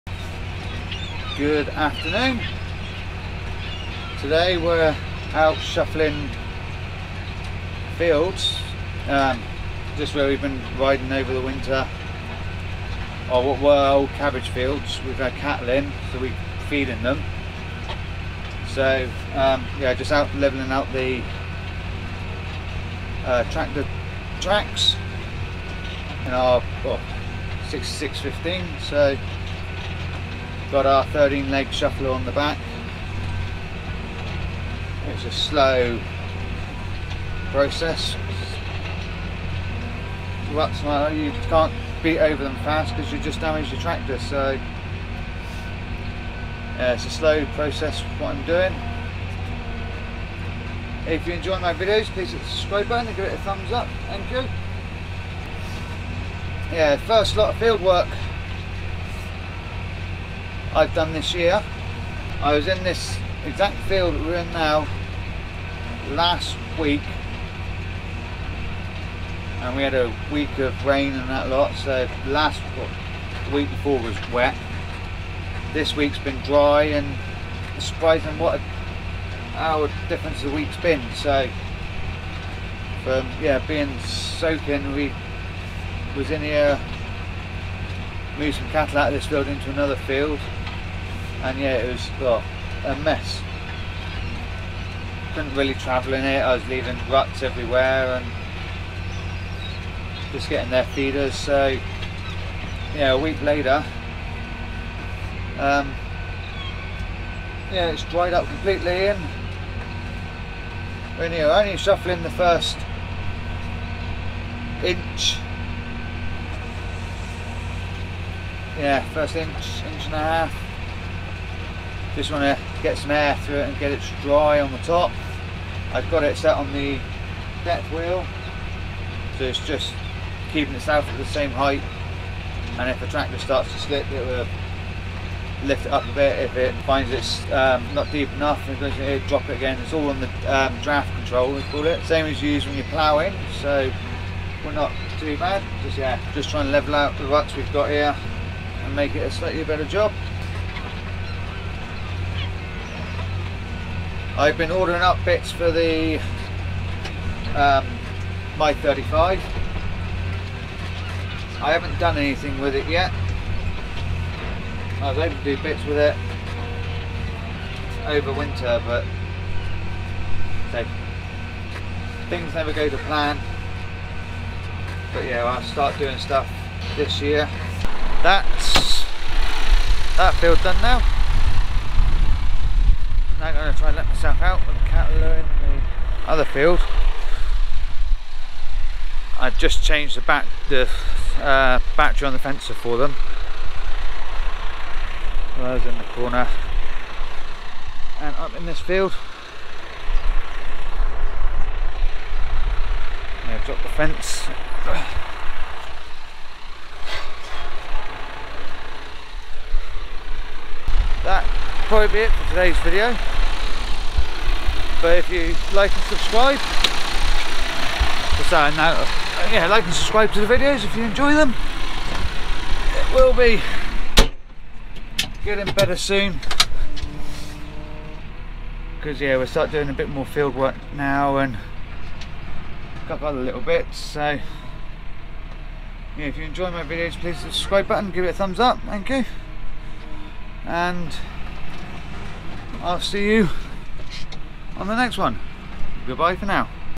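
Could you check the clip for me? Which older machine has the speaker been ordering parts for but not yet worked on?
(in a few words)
35.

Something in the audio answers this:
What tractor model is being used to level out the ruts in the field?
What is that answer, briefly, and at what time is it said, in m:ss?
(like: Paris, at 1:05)
6615, at 0:27.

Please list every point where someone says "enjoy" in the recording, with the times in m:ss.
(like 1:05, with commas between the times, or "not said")
0:51, 3:41, 3:56.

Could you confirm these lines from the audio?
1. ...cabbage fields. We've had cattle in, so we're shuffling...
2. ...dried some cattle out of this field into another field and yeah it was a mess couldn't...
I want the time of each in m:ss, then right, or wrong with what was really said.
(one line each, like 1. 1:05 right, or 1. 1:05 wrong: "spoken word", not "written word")
1. 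0:14 wrong: "feeding", not "shuffling"
2. 1:28 wrong: "moved", not "dried".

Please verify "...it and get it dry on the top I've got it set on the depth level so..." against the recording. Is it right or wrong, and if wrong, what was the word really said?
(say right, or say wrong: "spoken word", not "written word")
wrong: "wheel", not "level".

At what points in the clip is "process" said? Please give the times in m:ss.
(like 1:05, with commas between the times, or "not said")
0:37, 0:47.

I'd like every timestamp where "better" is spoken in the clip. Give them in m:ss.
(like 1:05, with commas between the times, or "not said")
2:29, 3:45.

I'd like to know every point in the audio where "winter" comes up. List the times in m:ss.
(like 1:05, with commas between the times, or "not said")
0:11, 2:48.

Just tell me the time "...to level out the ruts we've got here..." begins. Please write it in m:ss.
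2:26.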